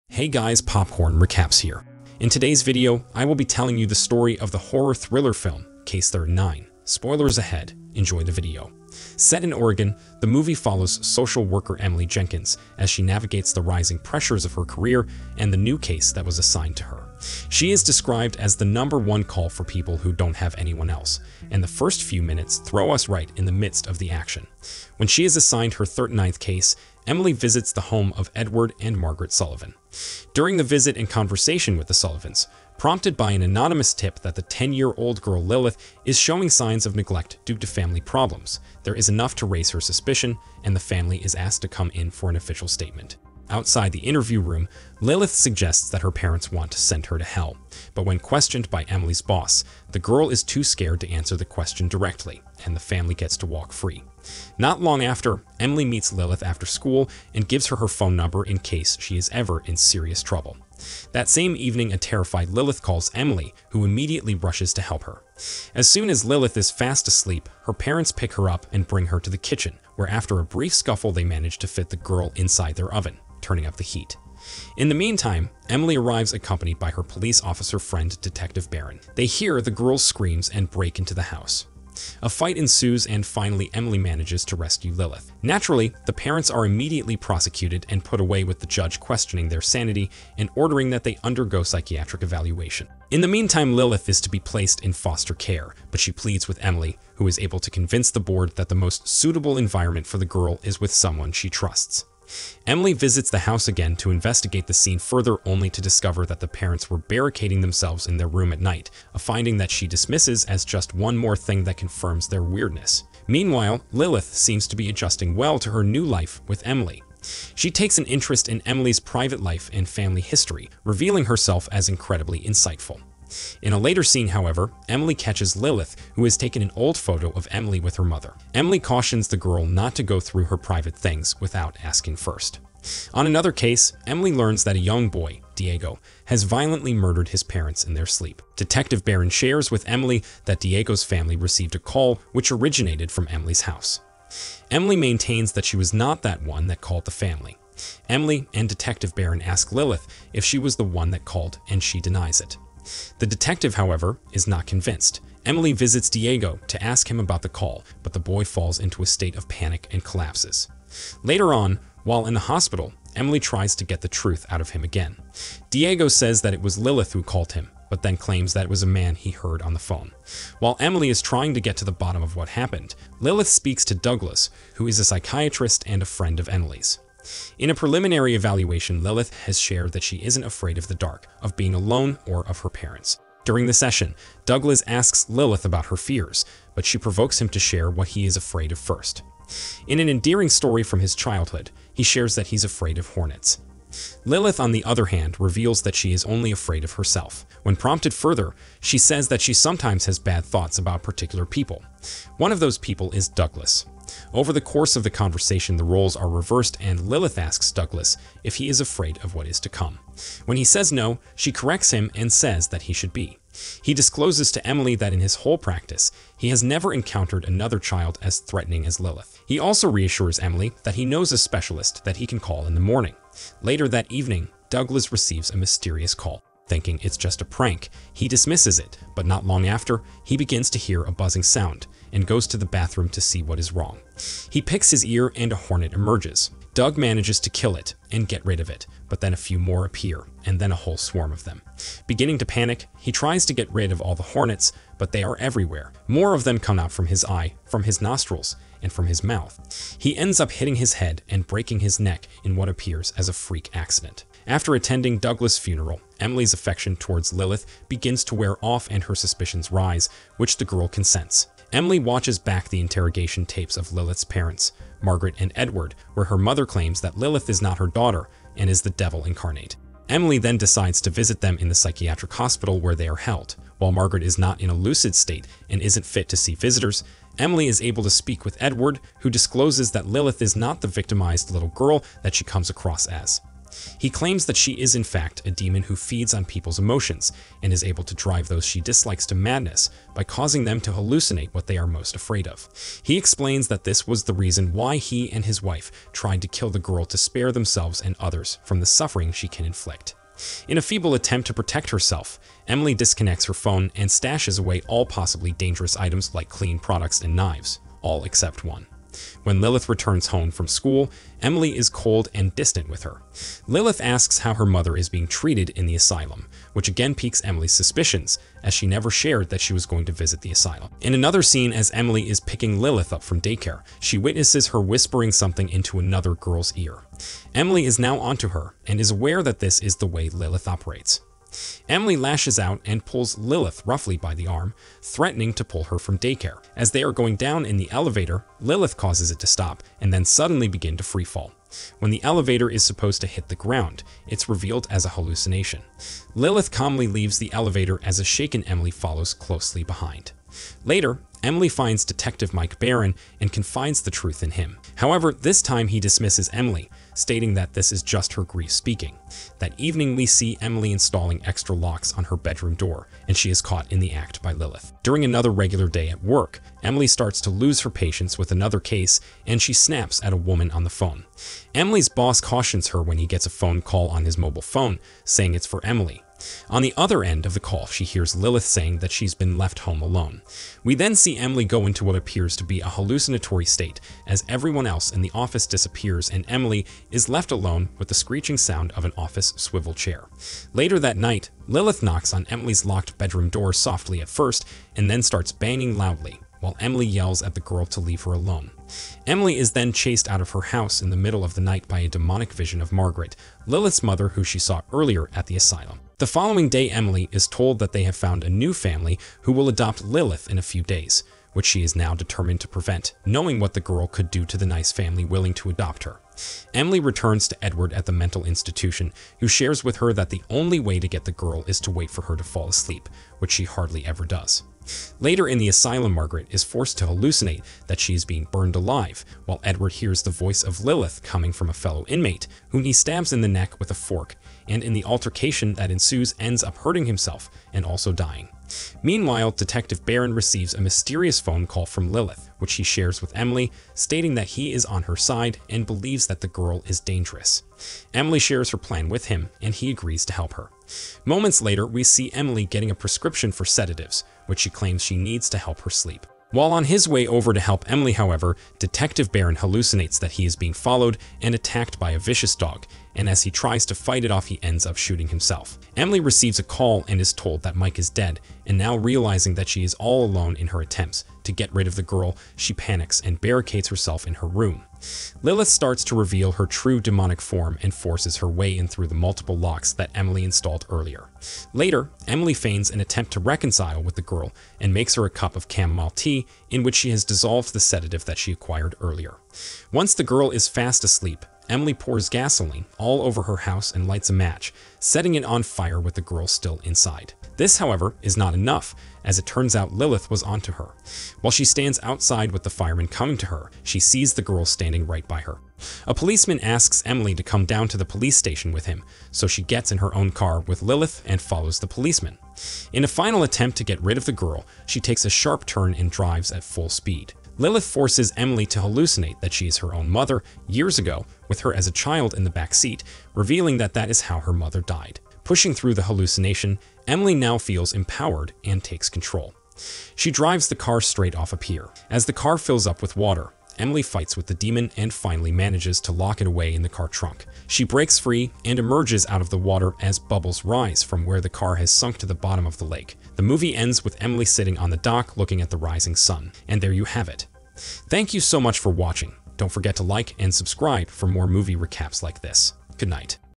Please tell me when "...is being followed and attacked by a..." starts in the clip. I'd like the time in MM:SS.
07:40.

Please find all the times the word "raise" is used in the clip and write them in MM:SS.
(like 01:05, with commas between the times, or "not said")
00:39.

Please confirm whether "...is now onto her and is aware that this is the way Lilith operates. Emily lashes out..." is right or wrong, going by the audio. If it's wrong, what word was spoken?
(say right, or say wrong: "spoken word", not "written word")
right.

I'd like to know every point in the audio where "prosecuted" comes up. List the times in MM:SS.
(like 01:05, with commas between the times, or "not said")
01:27.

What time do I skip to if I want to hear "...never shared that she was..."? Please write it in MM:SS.
05:18.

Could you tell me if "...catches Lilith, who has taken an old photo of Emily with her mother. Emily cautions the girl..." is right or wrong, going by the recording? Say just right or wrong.
right.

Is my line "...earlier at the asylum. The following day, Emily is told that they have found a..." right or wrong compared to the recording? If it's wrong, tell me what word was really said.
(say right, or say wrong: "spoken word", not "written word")
right.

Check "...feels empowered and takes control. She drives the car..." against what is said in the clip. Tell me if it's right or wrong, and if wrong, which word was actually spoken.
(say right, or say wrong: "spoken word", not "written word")
right.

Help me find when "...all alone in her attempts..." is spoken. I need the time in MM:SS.
07:49.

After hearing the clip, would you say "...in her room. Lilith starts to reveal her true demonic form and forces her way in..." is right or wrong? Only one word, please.
right.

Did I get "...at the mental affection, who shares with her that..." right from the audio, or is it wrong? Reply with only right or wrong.
wrong.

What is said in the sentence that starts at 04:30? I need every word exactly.
Emily then decides to visit them in the psychiatric hospital where they are held.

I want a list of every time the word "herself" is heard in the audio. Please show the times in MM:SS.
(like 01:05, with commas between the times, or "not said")
02:01, 03:16, 05:01, 07:53.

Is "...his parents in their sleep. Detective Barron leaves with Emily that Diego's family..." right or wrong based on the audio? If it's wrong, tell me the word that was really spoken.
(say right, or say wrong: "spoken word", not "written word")
wrong: "shares", not "leaves".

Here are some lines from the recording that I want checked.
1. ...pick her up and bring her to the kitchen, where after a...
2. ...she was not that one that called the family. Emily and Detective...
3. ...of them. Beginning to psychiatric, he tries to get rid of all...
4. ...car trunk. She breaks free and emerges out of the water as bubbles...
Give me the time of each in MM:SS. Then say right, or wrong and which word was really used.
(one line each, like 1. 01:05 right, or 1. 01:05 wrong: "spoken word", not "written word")
1. 01:08 right
2. 02:25 right
3. 04:01 wrong: "panic", not "psychiatric"
4. 08:56 right.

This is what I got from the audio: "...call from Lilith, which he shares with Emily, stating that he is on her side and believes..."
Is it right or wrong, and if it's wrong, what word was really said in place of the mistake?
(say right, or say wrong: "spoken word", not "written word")
right.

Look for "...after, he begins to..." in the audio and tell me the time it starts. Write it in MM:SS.
03:49.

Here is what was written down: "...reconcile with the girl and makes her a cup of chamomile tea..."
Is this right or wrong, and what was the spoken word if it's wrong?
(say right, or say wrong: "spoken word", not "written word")
right.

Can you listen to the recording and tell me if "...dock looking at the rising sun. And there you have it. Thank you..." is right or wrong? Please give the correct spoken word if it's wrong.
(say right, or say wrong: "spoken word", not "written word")
right.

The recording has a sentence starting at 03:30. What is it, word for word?
When he says no, she corrects him and says that he should be.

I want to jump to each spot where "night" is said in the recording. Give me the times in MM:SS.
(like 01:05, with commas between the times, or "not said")
01:48, 06:31, 06:41, 09:13.